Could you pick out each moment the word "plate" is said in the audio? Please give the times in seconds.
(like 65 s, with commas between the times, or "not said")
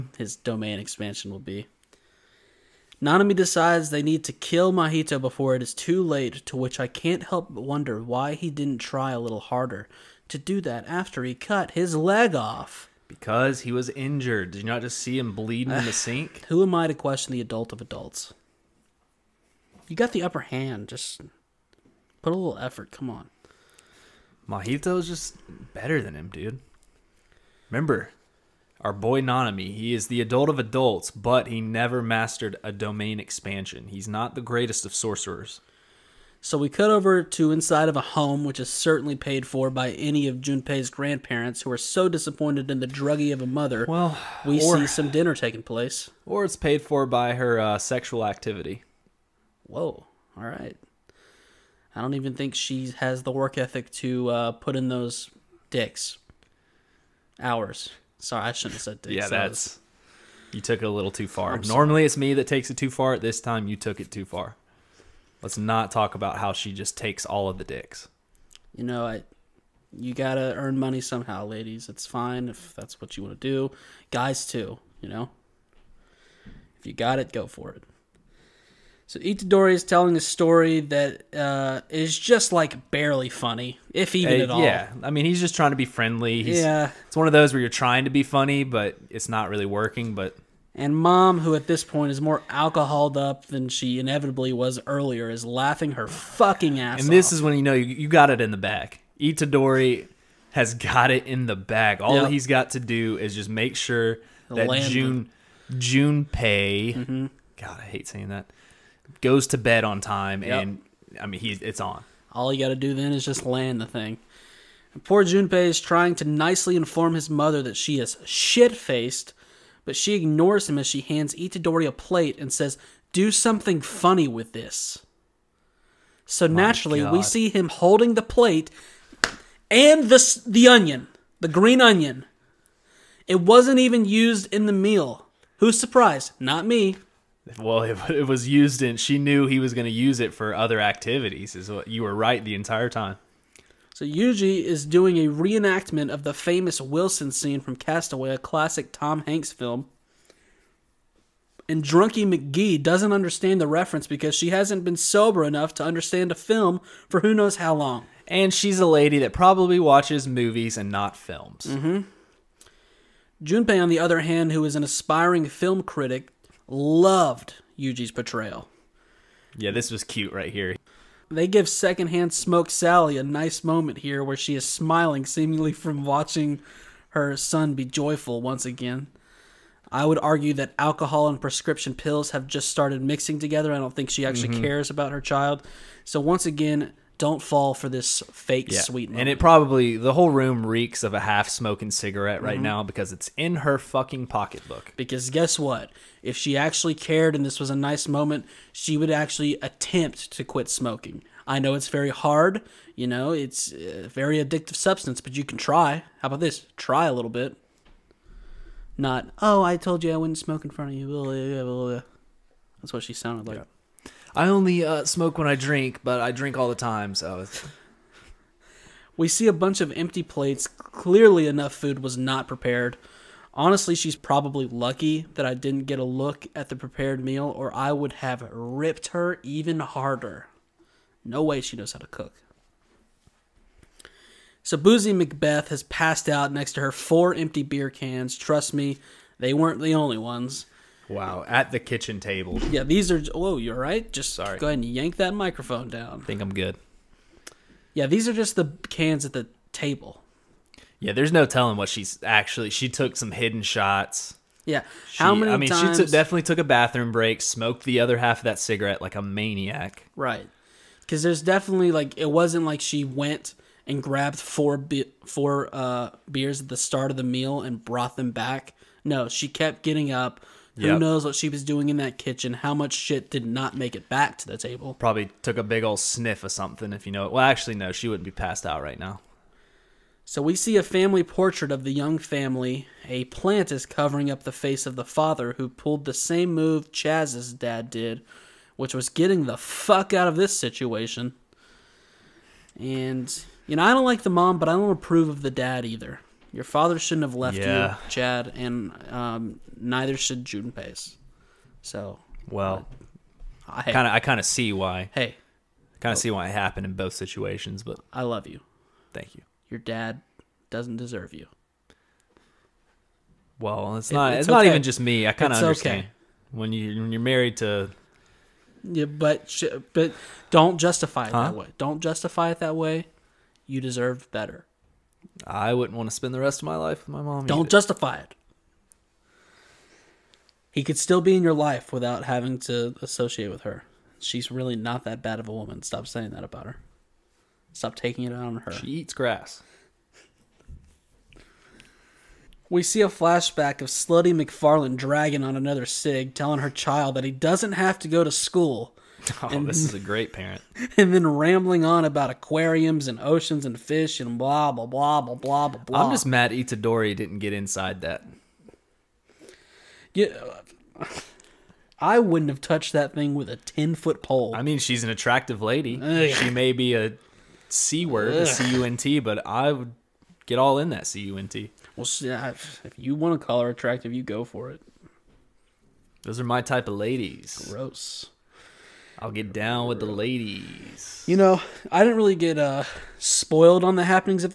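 121 s, 128 s, 220 s.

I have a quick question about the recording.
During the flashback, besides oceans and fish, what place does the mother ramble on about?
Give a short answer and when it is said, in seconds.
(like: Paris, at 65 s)
Aquariums, at 352 s.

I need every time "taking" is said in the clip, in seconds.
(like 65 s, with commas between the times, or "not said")
45 s, 337 s.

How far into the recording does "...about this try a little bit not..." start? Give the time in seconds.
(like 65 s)
206 s.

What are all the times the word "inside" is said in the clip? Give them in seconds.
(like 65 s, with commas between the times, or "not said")
37 s, 357 s.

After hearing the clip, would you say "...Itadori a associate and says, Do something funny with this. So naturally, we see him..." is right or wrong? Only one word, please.
wrong.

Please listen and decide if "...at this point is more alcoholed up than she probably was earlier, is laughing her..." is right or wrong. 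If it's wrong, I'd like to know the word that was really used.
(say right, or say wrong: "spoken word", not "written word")
wrong: "inevitably", not "probably".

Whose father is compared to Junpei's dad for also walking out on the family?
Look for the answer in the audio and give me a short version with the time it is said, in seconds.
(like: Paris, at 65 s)
Chaz, at 286 s.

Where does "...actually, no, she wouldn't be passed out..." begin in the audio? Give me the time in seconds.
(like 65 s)
277 s.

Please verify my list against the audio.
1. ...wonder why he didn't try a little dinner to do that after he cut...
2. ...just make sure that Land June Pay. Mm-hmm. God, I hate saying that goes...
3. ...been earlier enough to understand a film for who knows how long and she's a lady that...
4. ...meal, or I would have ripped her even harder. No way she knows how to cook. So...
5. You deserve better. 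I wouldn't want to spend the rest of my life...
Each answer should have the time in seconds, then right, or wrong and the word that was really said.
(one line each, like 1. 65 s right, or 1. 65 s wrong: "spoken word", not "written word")
1. 7 s wrong: "harder", not "dinner"
2. 103 s right
3. 154 s wrong: "sober", not "earlier"
4. 227 s right
5. 323 s right.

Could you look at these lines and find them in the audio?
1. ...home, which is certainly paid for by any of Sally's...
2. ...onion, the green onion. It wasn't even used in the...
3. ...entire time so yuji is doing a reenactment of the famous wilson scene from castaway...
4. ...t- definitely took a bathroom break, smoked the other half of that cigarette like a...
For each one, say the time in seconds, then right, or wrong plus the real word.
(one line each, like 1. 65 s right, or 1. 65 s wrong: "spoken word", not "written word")
1. 38 s wrong: "Junpei", not "Sally"
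2. 130 s right
3. 142 s right
4. 256 s right.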